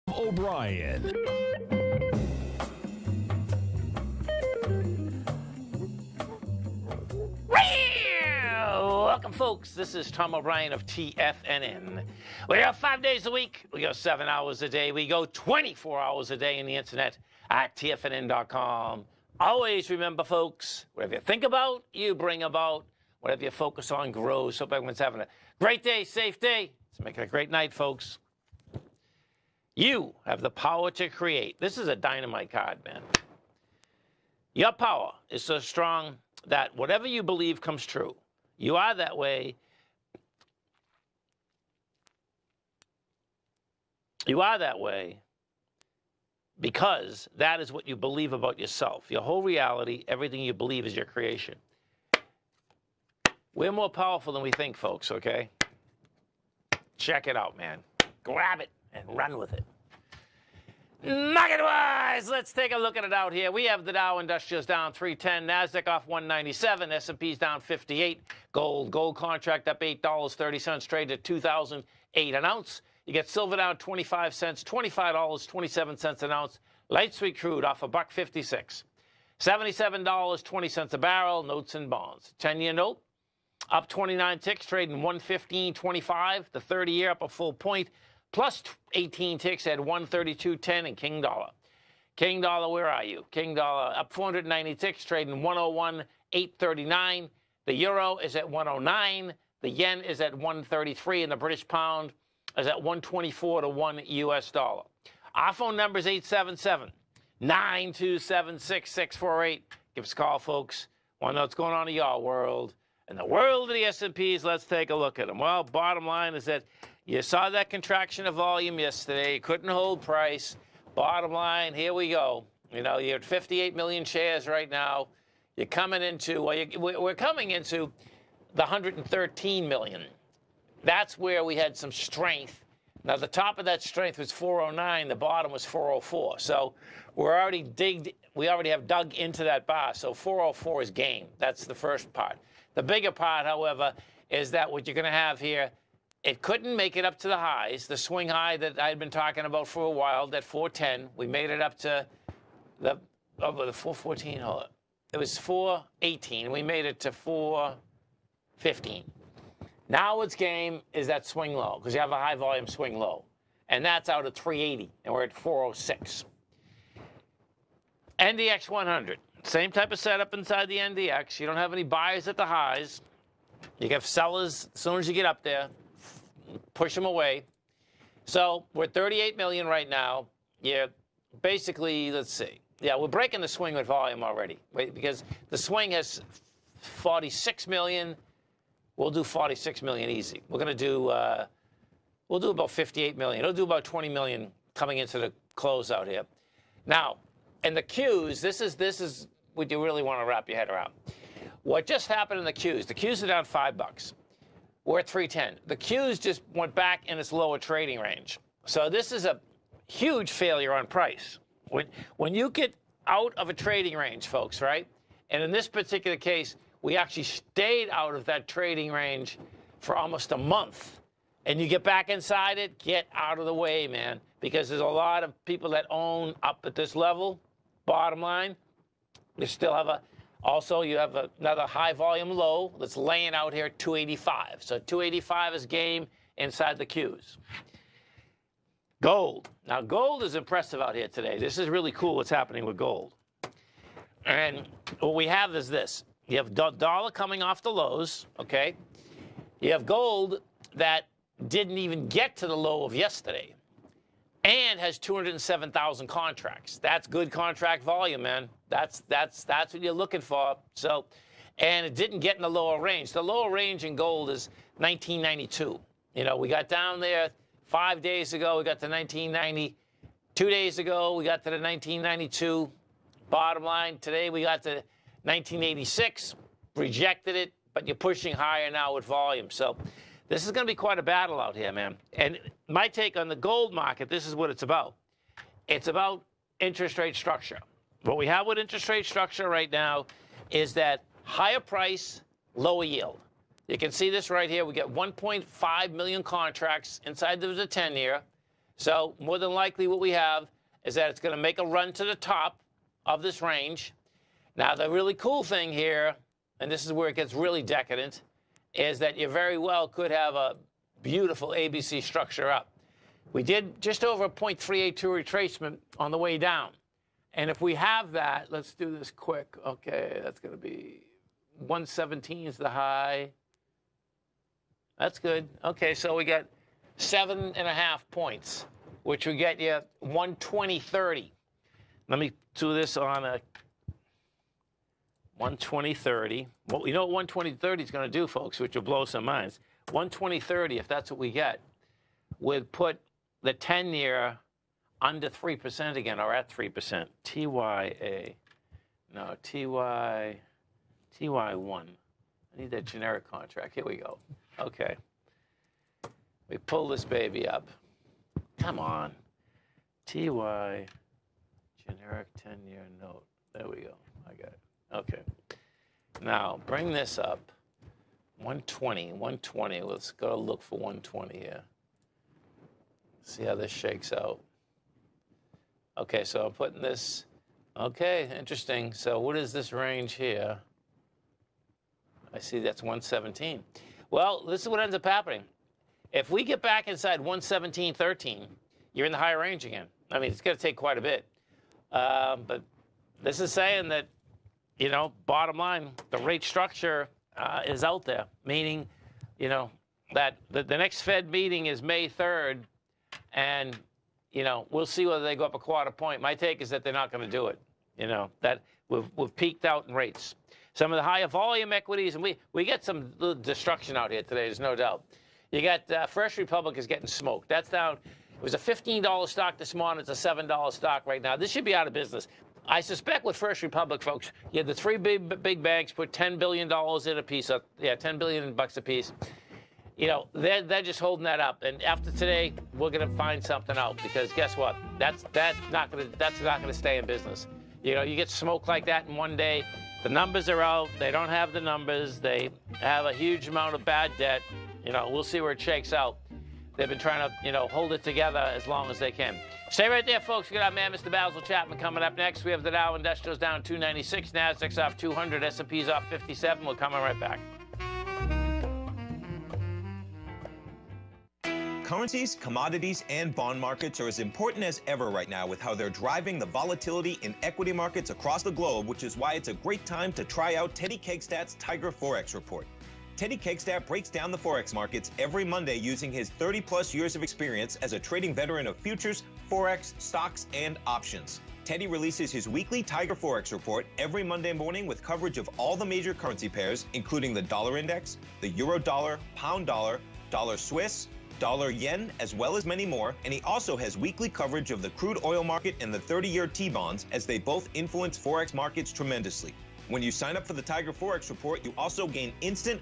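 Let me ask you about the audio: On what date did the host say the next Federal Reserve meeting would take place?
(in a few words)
May 3rd.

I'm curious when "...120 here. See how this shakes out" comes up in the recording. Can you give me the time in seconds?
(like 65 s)
370 s.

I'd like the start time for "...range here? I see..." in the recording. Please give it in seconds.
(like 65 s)
379 s.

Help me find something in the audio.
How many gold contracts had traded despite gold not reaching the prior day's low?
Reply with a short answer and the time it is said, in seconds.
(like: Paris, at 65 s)
207,000, at 254 s.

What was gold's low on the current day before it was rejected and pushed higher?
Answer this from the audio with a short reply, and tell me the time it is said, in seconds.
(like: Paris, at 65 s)
1986, at 273 s.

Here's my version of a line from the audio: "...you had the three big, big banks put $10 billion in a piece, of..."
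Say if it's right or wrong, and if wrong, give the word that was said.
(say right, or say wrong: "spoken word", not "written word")
right.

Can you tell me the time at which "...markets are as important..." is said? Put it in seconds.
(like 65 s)
463 s.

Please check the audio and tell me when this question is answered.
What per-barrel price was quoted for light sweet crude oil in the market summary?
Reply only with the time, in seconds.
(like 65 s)
79 s.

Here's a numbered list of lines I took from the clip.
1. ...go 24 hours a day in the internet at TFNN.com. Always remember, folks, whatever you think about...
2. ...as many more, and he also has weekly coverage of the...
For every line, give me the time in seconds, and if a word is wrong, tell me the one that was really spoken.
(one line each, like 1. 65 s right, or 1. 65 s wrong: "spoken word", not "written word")
1. 15 s right
2. 492 s right.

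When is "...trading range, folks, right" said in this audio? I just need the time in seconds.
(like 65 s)
213 s.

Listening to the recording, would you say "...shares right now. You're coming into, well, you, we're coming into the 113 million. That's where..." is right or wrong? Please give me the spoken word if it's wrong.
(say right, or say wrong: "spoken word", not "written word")
right.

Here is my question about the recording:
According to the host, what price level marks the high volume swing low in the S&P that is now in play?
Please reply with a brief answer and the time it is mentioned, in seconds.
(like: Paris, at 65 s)
380, at 163 s.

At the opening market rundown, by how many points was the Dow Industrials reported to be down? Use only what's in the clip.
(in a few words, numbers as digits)
310.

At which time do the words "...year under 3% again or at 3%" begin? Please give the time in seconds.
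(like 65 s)
343 s.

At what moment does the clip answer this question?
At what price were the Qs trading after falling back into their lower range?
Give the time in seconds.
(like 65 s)
204 s.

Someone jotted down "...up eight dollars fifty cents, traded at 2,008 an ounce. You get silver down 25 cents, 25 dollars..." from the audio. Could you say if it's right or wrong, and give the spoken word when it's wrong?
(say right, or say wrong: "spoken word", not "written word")
wrong: "thirty", not "fifty".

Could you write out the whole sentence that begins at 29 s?
You have the power to create.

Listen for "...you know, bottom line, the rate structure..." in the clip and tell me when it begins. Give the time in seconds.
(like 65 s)
394 s.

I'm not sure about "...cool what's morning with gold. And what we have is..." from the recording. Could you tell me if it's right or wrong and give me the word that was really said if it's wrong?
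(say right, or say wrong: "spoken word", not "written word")
wrong: "happening", not "morning".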